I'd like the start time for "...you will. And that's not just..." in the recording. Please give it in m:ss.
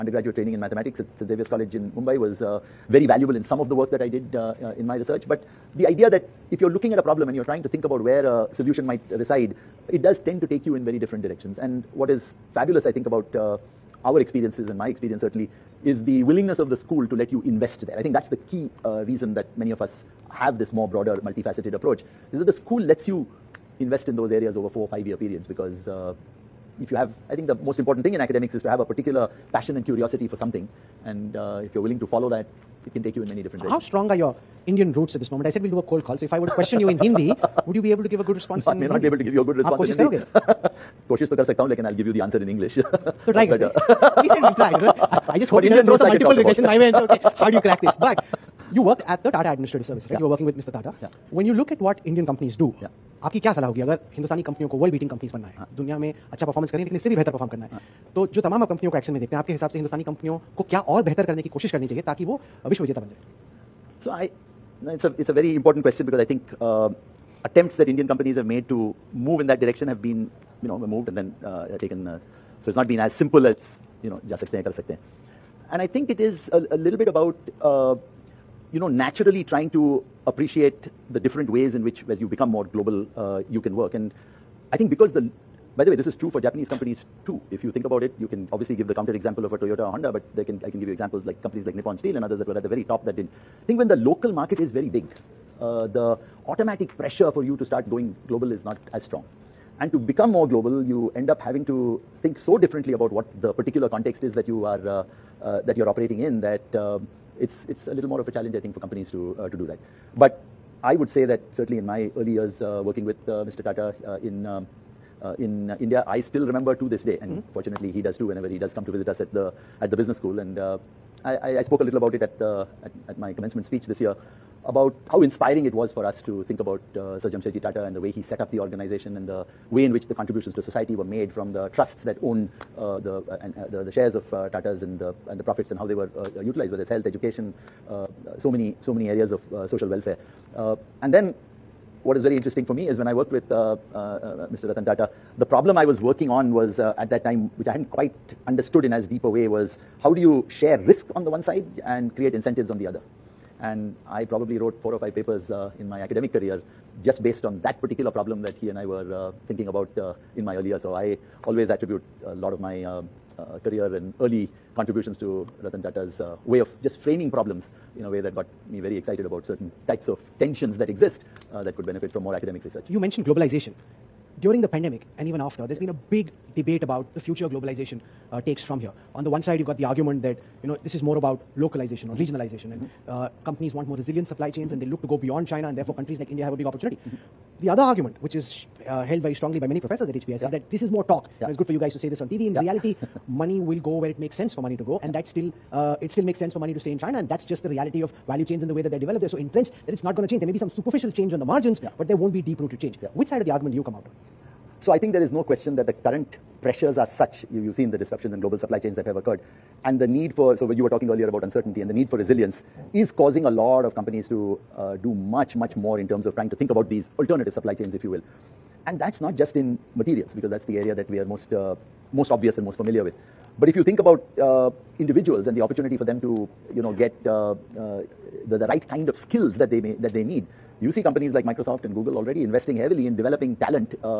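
3:38.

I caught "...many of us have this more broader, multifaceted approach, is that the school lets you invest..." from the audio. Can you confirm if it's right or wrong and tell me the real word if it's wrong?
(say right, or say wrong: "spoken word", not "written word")
right.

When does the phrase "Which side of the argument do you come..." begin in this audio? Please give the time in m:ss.
3:23.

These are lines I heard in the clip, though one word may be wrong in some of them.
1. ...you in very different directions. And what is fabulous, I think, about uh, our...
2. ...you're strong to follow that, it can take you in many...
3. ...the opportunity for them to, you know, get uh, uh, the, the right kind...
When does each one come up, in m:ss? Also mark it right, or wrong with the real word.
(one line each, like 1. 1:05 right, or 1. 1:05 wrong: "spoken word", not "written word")
1. 0:10 right
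2. 0:31 wrong: "willing", not "strong"
3. 3:45 right.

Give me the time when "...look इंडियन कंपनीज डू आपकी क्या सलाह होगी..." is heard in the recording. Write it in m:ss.
0:51.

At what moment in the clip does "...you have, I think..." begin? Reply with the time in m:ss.
0:26.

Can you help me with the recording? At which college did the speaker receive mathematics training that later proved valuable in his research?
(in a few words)
St Xavier's College.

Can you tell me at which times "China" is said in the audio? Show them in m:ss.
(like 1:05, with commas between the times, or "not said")
3:05, 3:16.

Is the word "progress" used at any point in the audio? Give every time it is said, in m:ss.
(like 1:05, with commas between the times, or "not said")
not said.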